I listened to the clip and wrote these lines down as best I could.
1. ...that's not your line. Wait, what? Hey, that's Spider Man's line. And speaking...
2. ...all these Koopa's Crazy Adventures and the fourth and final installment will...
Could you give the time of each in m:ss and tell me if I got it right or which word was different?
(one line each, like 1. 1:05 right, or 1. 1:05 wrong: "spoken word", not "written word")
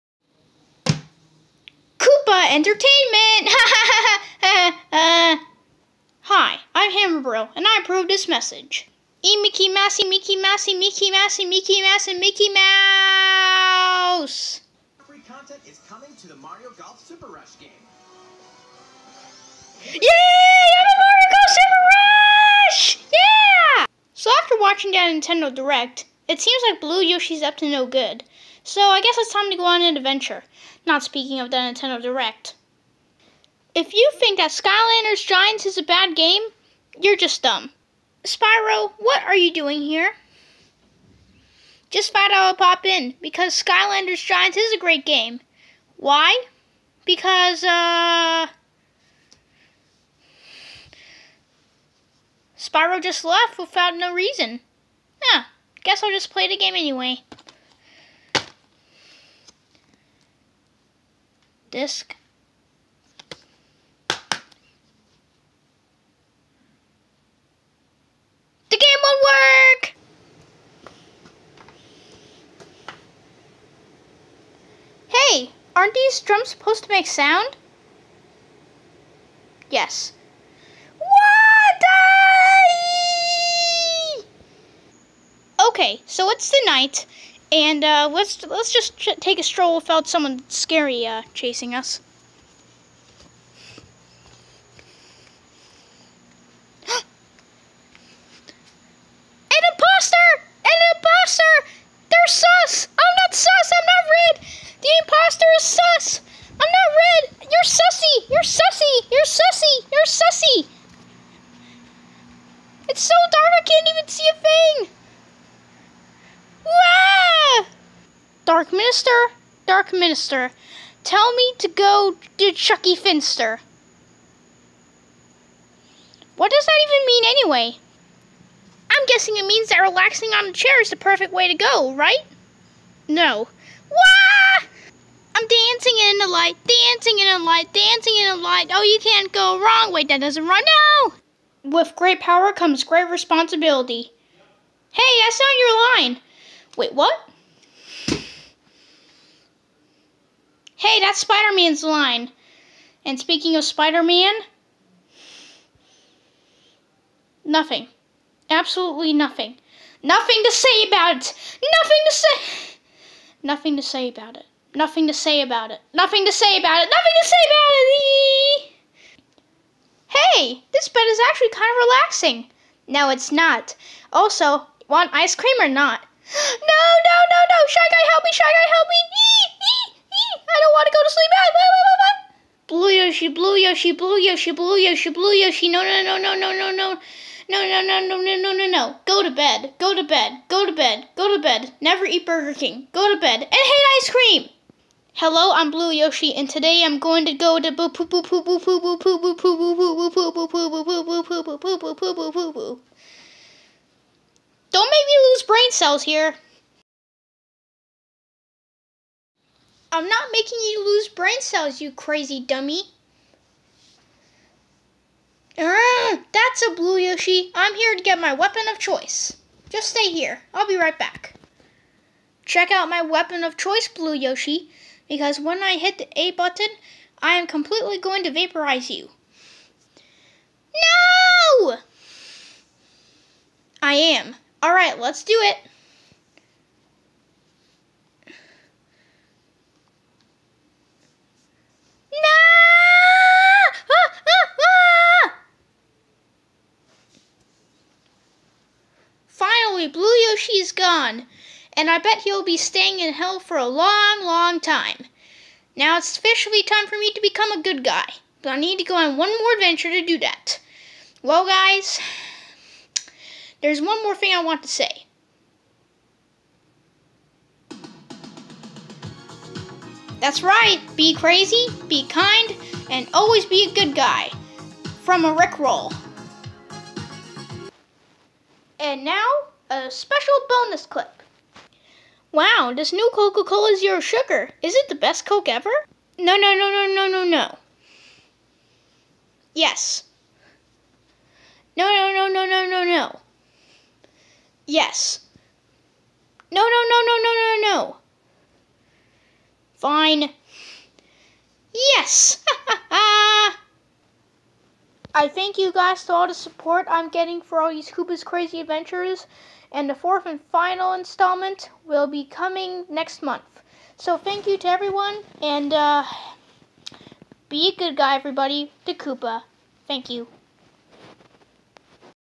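1. 2:25 right
2. 5:07 right.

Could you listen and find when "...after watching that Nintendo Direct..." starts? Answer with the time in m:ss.
0:24.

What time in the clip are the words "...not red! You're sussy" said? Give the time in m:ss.
1:46.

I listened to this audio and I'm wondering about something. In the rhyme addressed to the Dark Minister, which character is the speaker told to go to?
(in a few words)
Chuckie Finster.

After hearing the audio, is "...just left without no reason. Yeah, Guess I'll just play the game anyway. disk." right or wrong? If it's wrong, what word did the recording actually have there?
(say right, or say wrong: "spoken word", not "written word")
right.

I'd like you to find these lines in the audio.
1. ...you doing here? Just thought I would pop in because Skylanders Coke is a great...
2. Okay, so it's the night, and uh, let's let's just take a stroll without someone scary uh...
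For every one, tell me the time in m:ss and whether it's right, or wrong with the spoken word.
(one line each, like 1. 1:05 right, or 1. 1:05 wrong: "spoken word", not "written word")
1. 0:39 wrong: "Giants", not "Coke"
2. 1:25 right.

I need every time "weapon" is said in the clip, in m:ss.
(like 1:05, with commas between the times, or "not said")
3:38, 3:43.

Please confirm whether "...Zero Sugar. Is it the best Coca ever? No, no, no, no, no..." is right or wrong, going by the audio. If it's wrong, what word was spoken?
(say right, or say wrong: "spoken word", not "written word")
wrong: "Coke", not "Coca".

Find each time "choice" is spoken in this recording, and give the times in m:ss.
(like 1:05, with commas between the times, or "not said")
3:38, 3:43.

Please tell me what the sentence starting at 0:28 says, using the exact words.
So I guess it's time to go on an adventure.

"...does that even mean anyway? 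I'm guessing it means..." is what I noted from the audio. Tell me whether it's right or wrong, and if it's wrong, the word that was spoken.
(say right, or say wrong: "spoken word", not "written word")
right.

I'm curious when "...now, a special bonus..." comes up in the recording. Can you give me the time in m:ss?
4:39.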